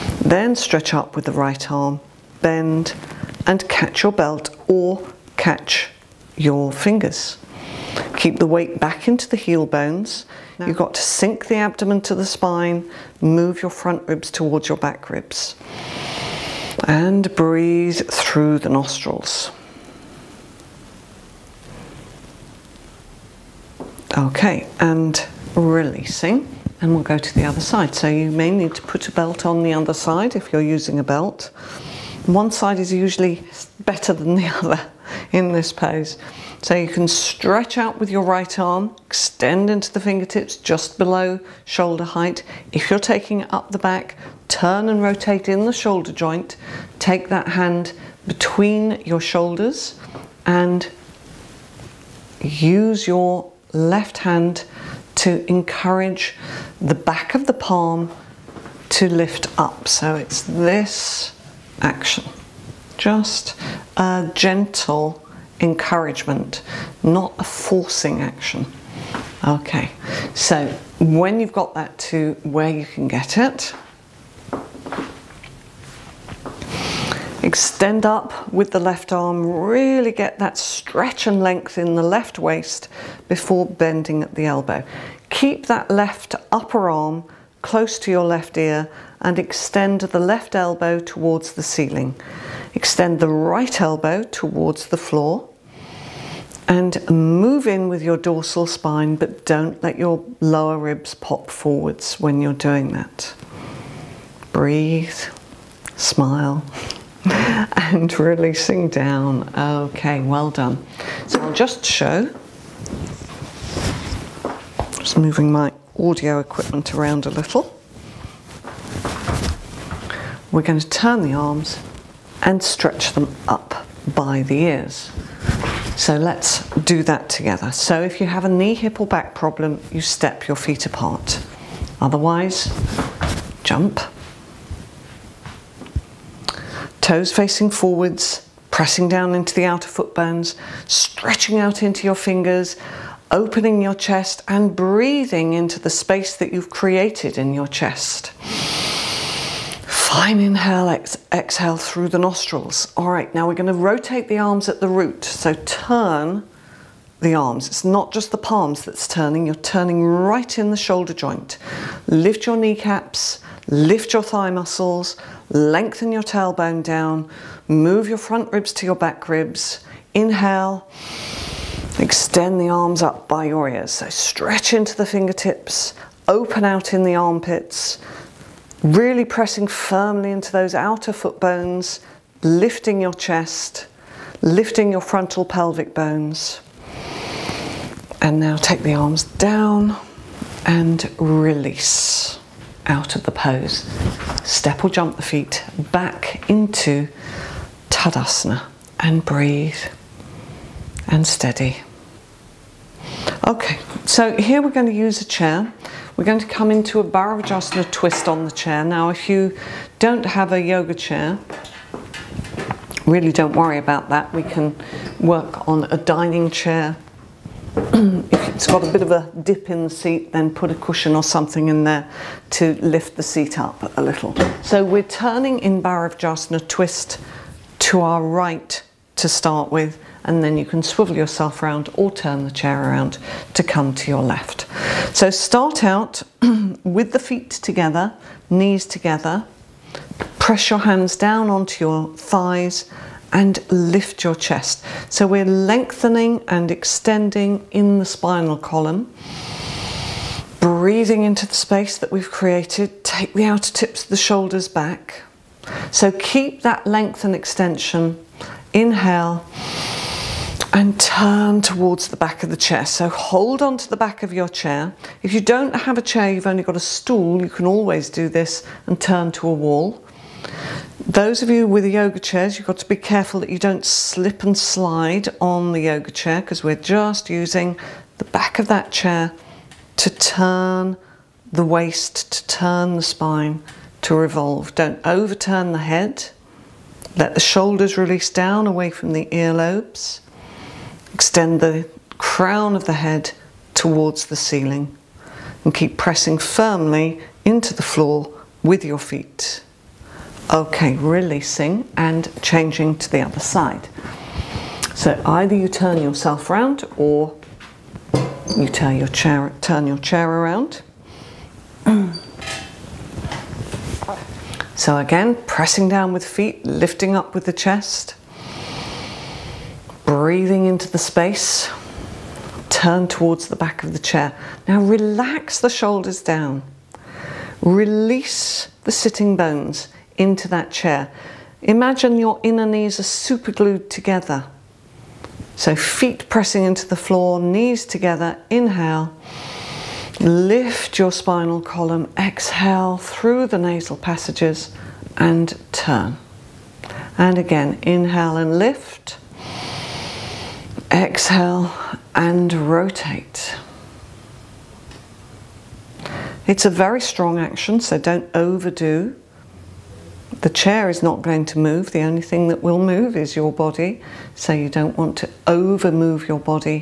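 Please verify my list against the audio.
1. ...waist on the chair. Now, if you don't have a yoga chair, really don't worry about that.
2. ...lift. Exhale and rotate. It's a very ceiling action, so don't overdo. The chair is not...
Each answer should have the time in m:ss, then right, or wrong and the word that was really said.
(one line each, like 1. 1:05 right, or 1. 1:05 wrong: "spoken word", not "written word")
1. 3:27 wrong: "twist", not "waist"
2. 5:48 wrong: "strong", not "ceiling".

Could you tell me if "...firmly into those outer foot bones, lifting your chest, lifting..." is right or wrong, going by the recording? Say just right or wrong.
right.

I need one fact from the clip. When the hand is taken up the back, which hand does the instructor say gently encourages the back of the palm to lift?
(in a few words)
Left hand.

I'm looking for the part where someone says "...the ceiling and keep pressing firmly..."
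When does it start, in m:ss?
4:54.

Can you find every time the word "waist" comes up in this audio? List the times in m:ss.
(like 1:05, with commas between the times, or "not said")
1:22, 4:41.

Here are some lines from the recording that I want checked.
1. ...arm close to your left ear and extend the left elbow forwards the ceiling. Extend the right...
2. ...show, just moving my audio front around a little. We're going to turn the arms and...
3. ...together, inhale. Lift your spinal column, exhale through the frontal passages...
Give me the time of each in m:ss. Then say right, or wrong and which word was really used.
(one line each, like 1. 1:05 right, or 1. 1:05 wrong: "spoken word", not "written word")
1. 1:26 wrong: "towards", not "forwards"
2. 1:51 wrong: "equipment", not "front"
3. 5:37 wrong: "nasal", not "frontal".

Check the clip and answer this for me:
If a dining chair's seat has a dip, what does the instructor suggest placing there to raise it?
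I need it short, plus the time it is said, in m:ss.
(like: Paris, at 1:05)
A cushion, at 3:40.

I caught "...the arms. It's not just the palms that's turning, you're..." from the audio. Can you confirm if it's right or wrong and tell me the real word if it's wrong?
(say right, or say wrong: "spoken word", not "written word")
right.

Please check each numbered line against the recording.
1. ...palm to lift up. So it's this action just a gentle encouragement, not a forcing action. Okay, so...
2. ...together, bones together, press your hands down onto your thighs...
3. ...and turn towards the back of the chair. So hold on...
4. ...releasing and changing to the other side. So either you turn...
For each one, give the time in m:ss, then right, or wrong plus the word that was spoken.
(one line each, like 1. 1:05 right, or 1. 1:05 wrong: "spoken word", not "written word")
1. 0:57 right
2. 3:57 wrong: "knees", not "bones"
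3. 4:20 right
4. 5:00 right.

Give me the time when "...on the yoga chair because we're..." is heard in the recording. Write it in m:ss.
4:35.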